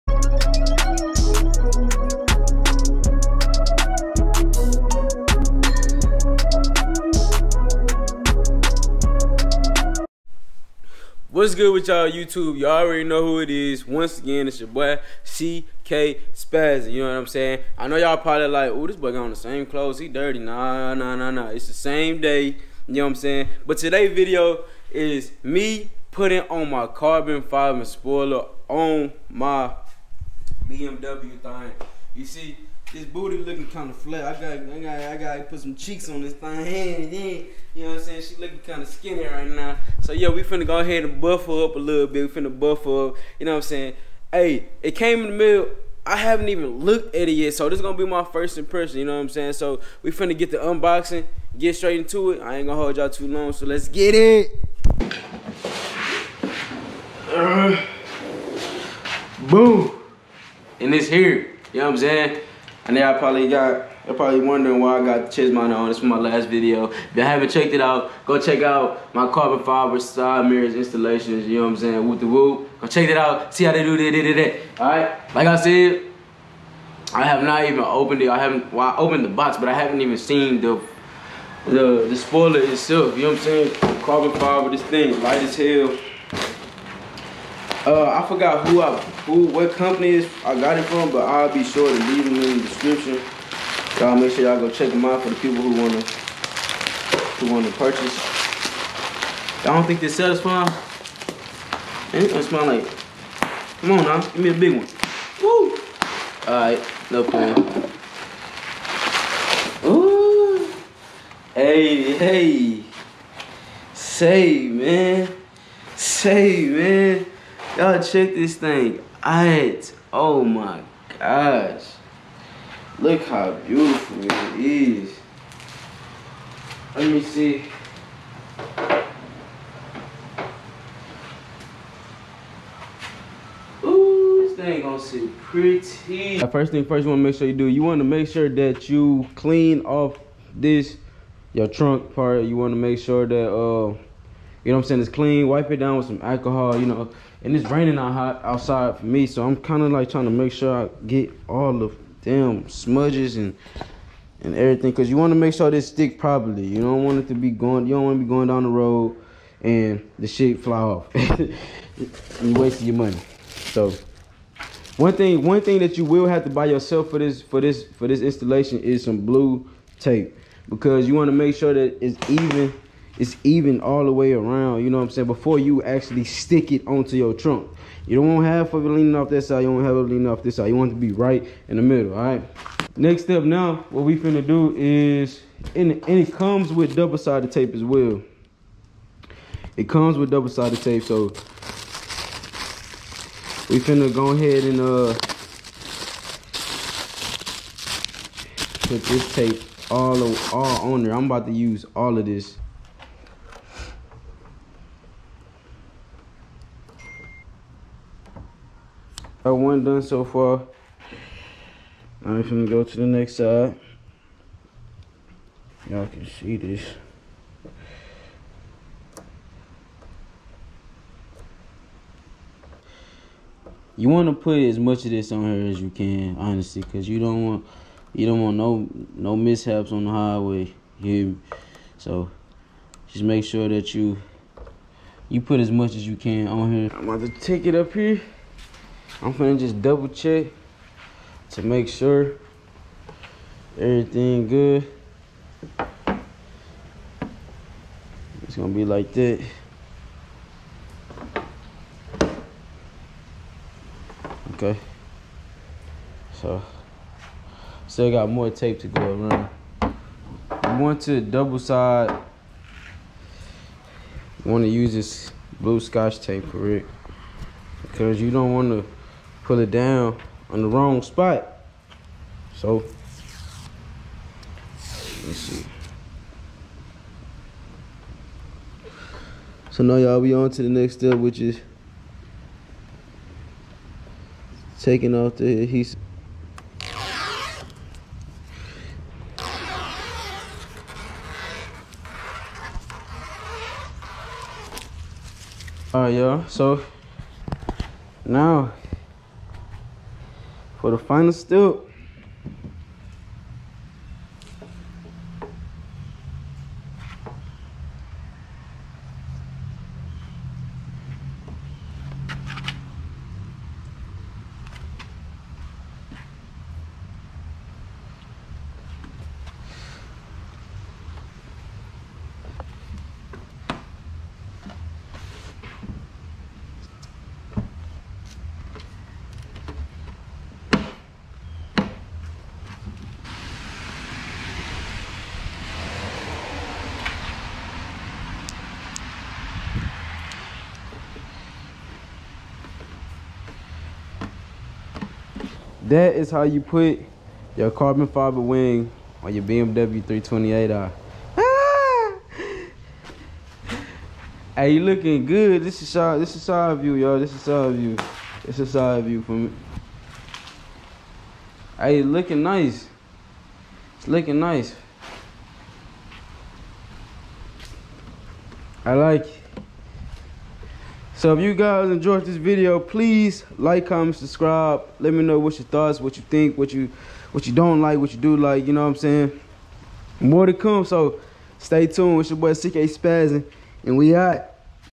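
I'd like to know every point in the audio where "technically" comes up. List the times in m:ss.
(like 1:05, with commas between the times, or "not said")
not said.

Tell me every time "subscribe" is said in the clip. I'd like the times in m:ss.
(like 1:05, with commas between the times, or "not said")
6:14.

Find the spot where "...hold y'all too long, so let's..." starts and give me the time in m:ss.
0:52.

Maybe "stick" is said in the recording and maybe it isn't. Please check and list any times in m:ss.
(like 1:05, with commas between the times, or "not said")
2:35, 2:56.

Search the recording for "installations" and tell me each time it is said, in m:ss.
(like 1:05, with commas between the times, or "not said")
1:10, 2:48.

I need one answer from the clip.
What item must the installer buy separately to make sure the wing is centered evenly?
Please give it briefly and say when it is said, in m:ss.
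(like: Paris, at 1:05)
Blue tape, at 2:49.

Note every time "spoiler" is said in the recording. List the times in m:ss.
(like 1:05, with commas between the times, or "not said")
0:27, 1:22.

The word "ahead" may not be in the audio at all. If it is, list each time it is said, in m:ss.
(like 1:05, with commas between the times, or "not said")
0:40, 3:14.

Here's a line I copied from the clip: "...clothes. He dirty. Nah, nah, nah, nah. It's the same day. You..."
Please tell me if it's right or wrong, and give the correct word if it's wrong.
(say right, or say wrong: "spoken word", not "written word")
right.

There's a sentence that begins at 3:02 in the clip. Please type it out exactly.
Next step now, what we finna do is, and, and it comes with double-sided tape as well.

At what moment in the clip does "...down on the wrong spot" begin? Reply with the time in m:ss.
4:29.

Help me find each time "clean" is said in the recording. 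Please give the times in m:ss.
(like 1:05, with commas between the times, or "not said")
2:19, 2:25.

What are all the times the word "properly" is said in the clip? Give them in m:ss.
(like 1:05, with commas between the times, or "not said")
2:36.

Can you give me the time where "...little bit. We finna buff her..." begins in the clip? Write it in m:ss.
0:41.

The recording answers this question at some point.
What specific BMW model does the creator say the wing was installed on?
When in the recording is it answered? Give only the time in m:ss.
5:49.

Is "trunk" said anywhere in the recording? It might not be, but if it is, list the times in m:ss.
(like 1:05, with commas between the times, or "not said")
2:21, 2:57.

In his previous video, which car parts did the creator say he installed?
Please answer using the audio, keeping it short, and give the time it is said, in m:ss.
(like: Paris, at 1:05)
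Side mirrors, at 1:09.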